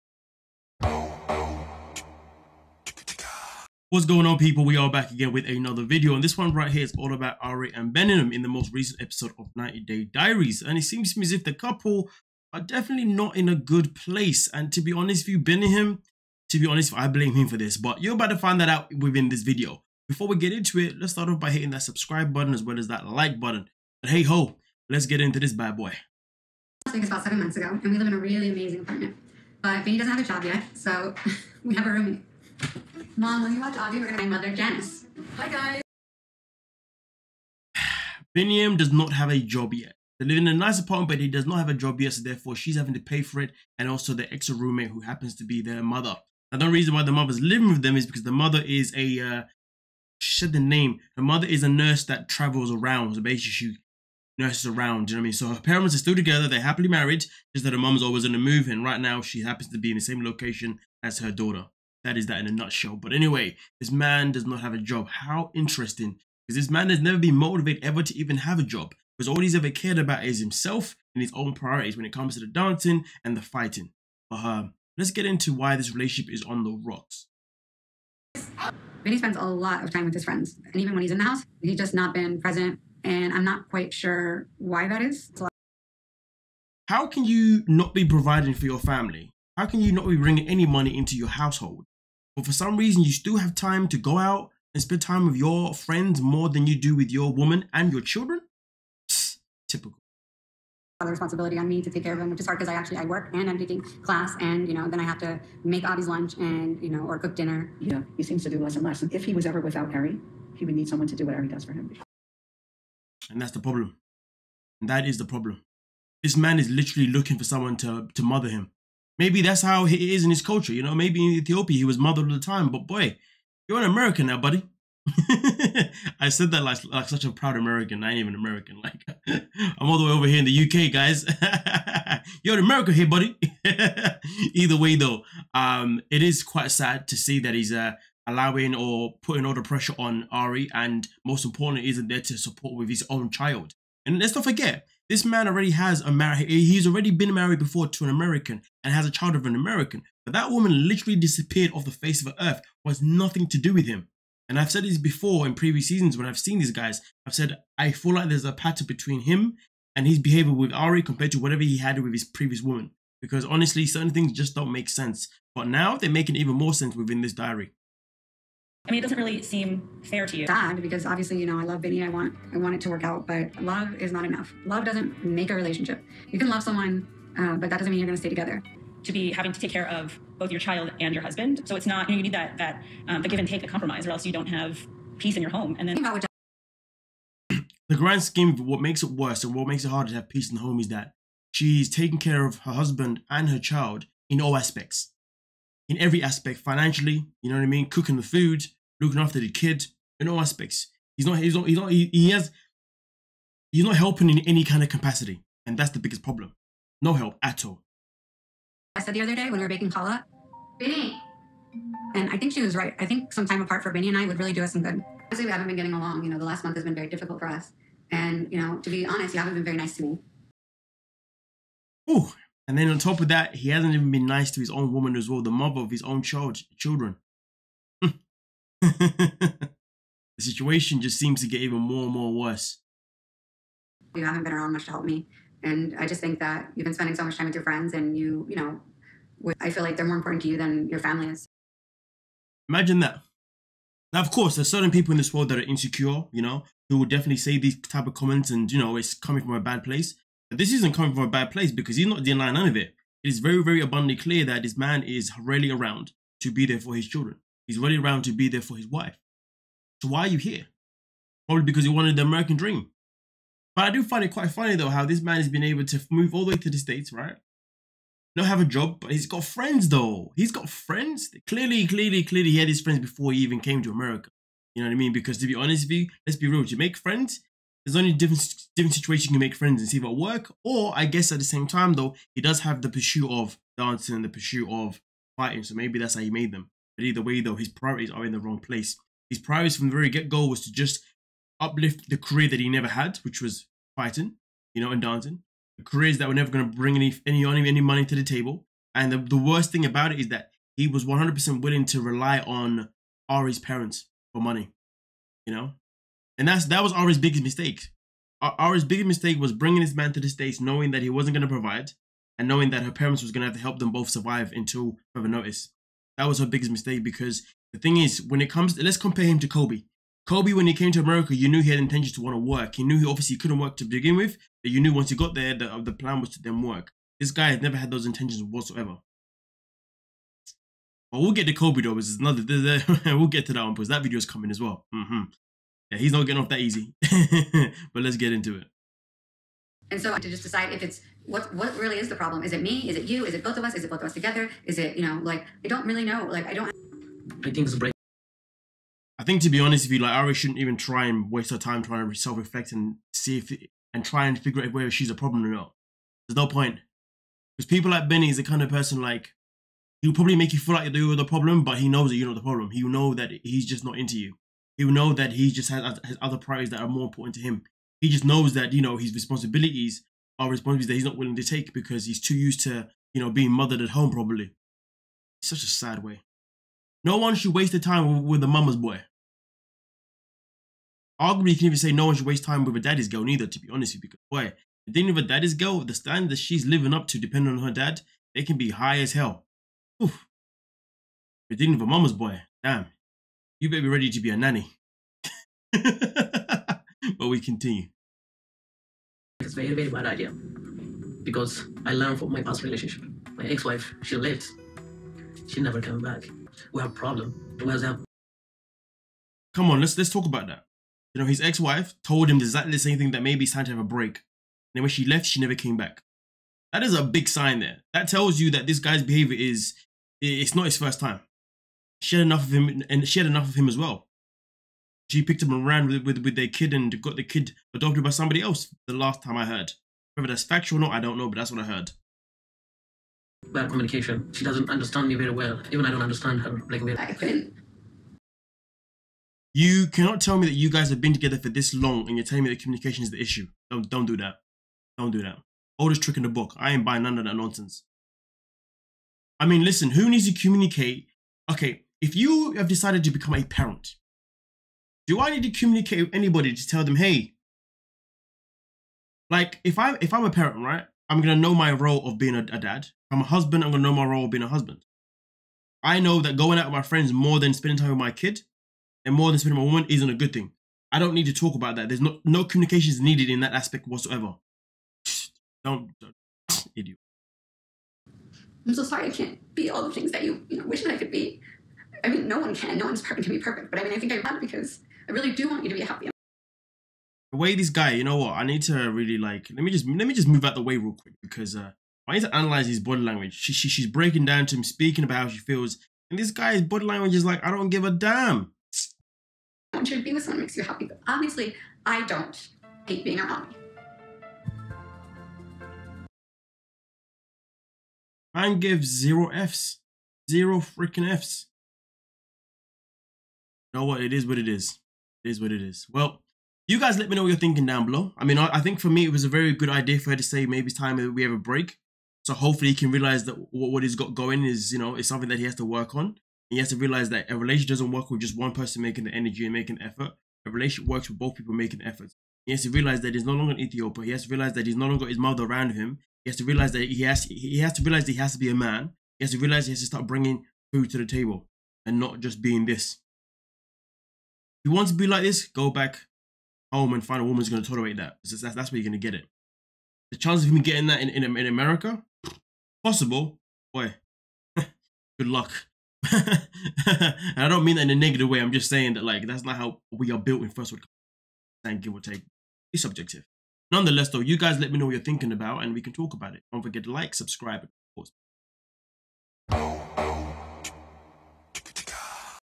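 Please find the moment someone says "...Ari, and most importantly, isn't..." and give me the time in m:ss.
2:20.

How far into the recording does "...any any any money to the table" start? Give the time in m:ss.
4:56.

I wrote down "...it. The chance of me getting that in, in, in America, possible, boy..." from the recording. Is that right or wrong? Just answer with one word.
right.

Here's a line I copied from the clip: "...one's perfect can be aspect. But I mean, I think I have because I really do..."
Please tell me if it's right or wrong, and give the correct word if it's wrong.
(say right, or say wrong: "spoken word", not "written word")
wrong: "perfect", not "aspect".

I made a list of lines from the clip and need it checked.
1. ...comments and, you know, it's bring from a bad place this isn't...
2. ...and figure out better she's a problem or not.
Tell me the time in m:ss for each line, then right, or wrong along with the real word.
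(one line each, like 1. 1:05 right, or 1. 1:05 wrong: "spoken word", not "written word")
1. 4:08 wrong: "coming", not "bring"
2. 5:54 wrong: "whether", not "better".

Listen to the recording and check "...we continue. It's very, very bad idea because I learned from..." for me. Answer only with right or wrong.
right.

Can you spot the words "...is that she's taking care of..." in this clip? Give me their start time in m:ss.
3:10.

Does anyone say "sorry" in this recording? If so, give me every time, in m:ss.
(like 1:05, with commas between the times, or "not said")
7:58.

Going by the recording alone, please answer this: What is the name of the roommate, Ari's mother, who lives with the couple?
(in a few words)
Janice.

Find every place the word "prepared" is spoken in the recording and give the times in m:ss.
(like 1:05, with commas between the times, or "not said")
not said.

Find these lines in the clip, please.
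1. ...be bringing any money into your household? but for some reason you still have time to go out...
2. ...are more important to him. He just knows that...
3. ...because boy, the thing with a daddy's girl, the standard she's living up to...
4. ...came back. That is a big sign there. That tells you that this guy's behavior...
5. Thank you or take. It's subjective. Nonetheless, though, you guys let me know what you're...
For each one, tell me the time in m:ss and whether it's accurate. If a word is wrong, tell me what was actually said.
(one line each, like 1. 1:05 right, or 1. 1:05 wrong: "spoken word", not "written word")
1. 1:30 right
2. 6:06 right
3. 6:24 right
4. 6:55 right
5. 9:21 right.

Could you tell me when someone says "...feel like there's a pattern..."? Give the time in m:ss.
2:37.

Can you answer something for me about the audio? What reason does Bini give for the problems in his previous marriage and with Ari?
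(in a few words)
Bad communication.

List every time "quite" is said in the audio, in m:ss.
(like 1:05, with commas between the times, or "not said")
1:23, 2:16, 4:24.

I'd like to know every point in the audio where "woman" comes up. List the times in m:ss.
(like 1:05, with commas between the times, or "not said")
1:37, 2:30, 2:42, 3:44, 7:49, 9:07.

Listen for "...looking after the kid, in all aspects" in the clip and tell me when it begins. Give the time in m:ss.
3:19.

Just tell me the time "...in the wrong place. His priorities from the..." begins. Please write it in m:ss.
4:48.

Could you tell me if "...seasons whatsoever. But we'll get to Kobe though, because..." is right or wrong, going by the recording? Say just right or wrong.
wrong.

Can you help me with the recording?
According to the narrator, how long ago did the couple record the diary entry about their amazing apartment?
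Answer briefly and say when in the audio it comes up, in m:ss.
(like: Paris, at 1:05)
7 months, at 0:27.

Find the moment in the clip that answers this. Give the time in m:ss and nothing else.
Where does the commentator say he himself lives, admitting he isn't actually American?
2:10.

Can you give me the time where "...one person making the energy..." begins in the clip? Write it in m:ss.
8:48.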